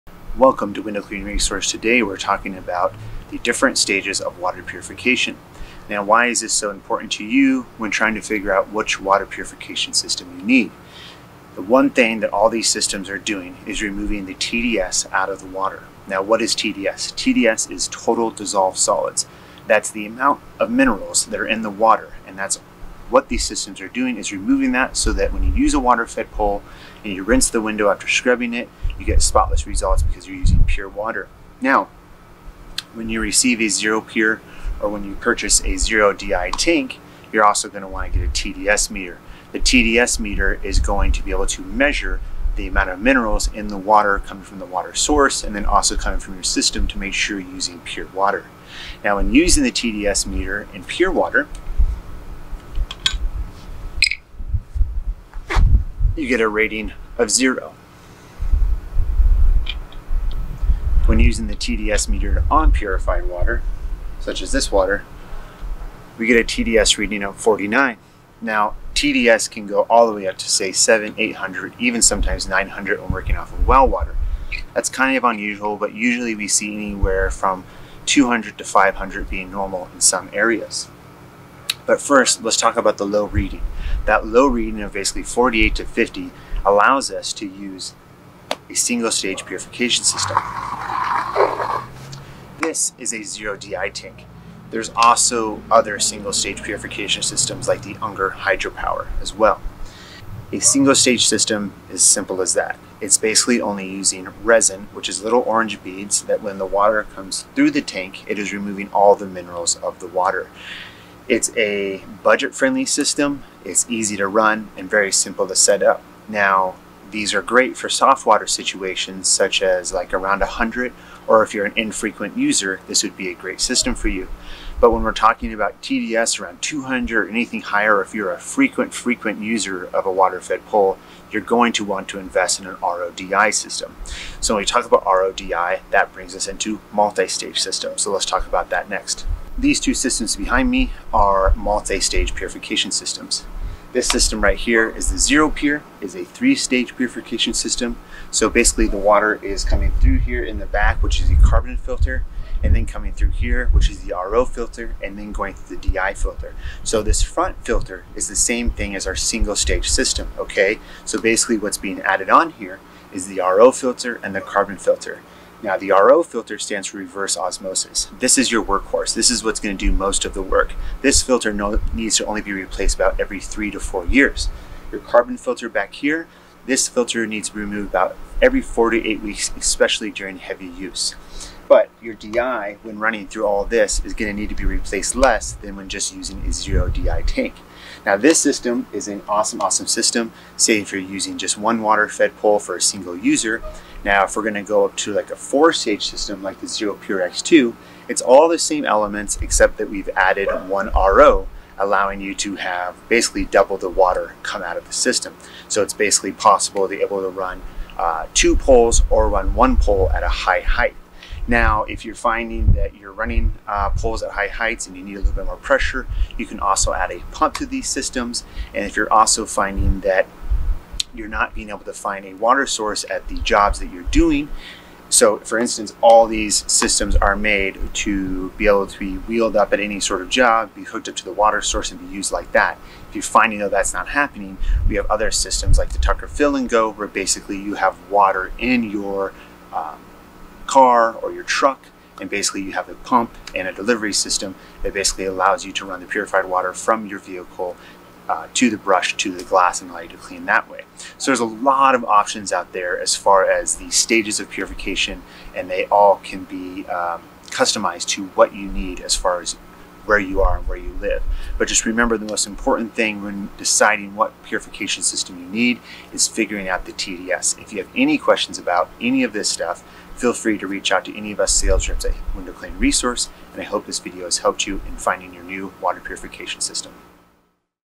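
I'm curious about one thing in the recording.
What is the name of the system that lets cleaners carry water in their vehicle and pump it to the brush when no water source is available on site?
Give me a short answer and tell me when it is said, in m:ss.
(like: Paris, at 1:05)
Tucker Fill and Go, at 3:55.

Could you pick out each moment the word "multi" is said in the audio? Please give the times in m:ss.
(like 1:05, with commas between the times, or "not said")
2:16, 2:21.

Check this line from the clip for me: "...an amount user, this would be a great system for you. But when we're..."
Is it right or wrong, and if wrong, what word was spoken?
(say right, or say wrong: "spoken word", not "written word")
wrong: "infrequent", not "amount".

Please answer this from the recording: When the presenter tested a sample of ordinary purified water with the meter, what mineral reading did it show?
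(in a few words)
49.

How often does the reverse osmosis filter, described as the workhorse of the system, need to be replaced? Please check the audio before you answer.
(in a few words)
Every 3 to 4 years.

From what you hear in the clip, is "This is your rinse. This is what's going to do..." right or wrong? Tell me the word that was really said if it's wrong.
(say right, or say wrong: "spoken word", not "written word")
wrong: "workhorse", not "rinse".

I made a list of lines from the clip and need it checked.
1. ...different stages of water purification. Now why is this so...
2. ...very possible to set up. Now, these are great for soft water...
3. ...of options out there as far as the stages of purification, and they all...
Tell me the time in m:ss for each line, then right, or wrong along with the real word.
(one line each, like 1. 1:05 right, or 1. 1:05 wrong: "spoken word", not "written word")
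1. 0:03 right
2. 1:54 wrong: "simple", not "possible"
3. 4:11 right.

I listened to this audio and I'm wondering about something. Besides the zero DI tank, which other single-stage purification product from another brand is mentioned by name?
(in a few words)
Unger hydropower.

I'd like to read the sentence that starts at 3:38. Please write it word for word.
And if you're also finding that you're not being able to find a water source at the jobs that you're doing.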